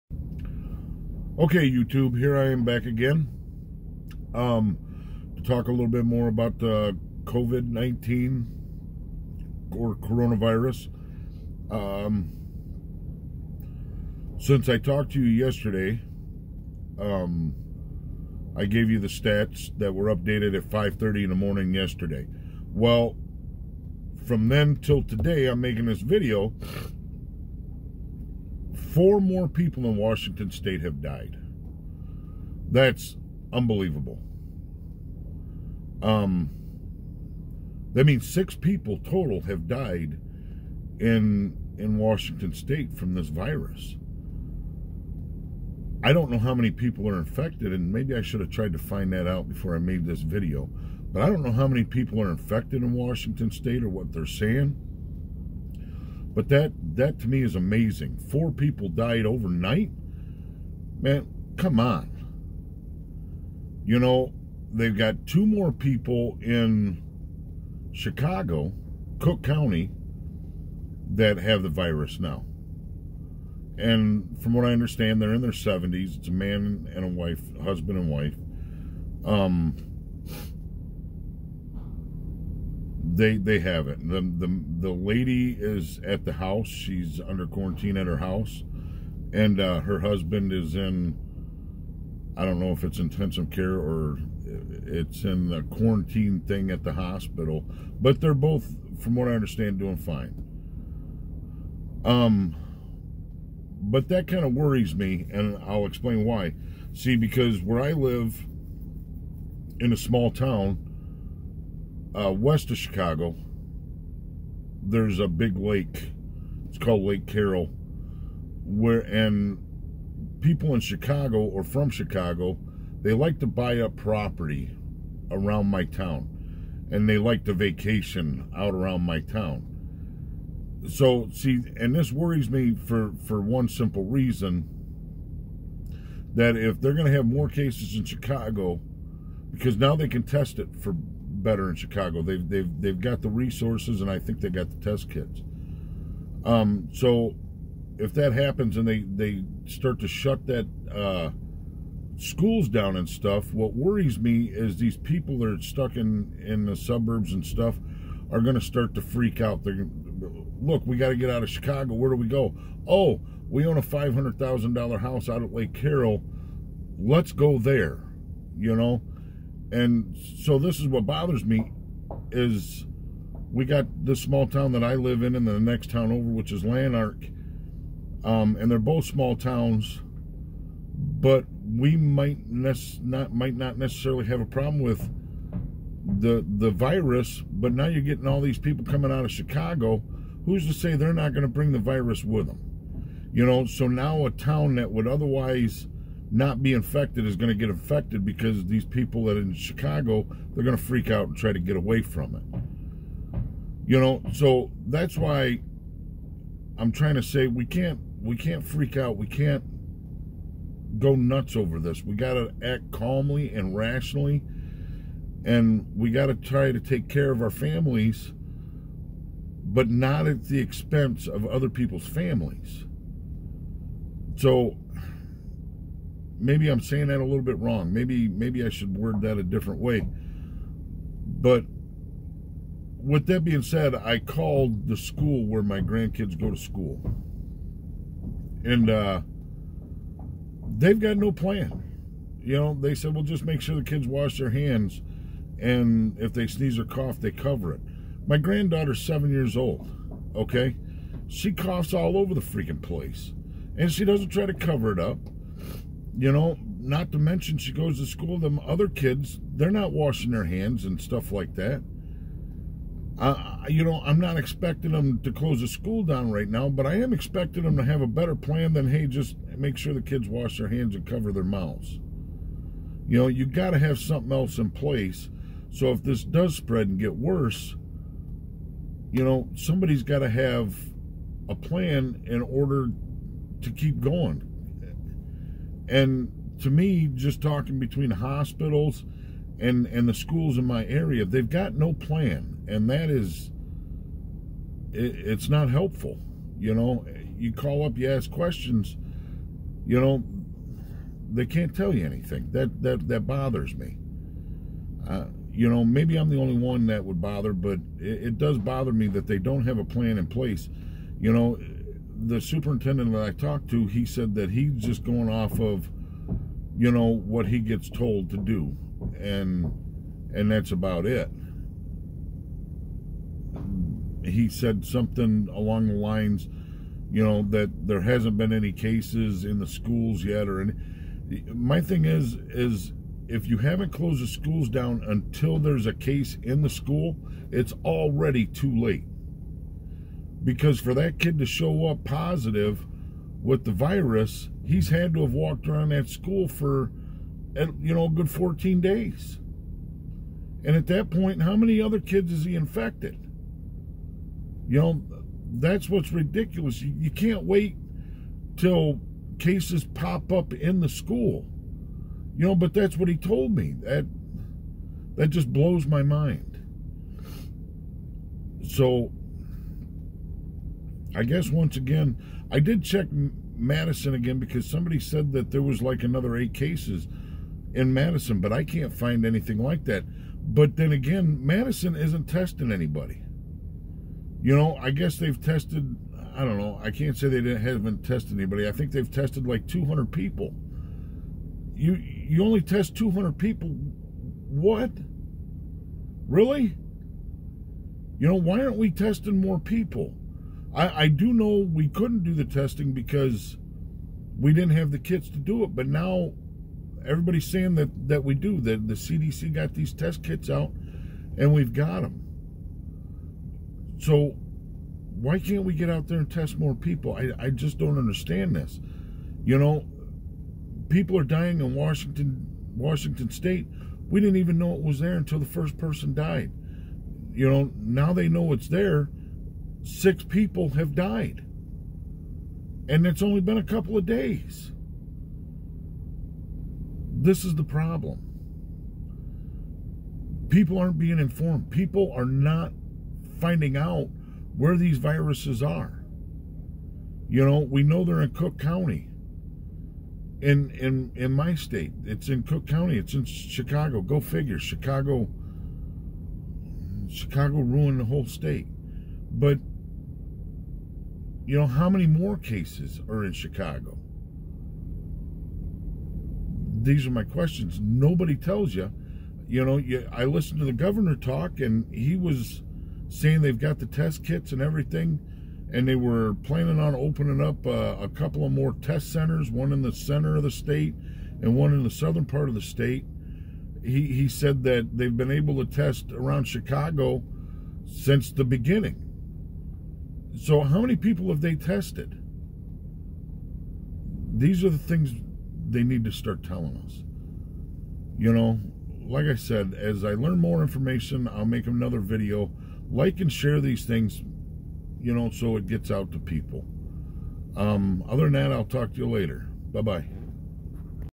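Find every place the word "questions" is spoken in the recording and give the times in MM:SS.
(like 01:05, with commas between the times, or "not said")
04:58, 07:47.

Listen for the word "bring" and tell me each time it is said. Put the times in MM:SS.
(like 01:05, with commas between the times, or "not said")
03:11.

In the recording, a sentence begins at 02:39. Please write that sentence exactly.
They're look, we got to get out of Chicago.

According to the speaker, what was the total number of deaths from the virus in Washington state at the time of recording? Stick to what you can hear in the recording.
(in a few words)
6.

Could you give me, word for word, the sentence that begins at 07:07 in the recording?
You know, now they know it's there six people have died.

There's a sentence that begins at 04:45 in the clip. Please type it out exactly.
And to me, just talking between hospitals and, and the schools in my area, they've got no plan.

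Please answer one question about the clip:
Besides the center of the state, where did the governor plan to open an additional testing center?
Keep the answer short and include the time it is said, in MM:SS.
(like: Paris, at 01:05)
southern part of the state, at 08:01.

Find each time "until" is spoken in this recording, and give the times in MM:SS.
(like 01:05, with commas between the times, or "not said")
05:35, 07:05.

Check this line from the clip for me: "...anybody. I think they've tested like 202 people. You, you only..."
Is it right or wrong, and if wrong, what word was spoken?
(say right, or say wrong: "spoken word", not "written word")
wrong: "200", not "202".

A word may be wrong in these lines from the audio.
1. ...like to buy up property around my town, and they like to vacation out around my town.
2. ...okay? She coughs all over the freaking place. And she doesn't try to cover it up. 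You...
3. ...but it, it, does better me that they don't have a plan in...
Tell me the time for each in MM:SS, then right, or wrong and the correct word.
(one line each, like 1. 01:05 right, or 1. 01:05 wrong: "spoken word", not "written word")
1. 02:03 right
2. 04:10 right
3. 05:07 wrong: "bother", not "better".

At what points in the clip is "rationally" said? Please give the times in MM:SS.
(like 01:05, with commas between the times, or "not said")
03:33.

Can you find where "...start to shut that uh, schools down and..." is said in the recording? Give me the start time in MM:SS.
02:29.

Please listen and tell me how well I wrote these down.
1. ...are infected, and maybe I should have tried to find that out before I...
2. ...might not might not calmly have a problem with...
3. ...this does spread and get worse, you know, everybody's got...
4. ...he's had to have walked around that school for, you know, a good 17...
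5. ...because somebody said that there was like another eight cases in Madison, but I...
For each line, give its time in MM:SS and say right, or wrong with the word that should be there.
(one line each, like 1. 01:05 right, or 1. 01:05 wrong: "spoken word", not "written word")
1. 00:47 right
2. 03:01 wrong: "necessarily", not "calmly"
3. 04:36 wrong: "somebody", not "everybody"
4. 05:44 wrong: "14", not "17"
5. 06:14 right.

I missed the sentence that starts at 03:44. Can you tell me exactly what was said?
So maybe I'm saying that a little bit wrong.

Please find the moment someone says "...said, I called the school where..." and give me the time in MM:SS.
03:53.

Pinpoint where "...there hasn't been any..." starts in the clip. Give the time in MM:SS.
05:27.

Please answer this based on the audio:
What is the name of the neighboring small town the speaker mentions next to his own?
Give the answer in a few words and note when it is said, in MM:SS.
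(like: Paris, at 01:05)
Lanark, at 02:56.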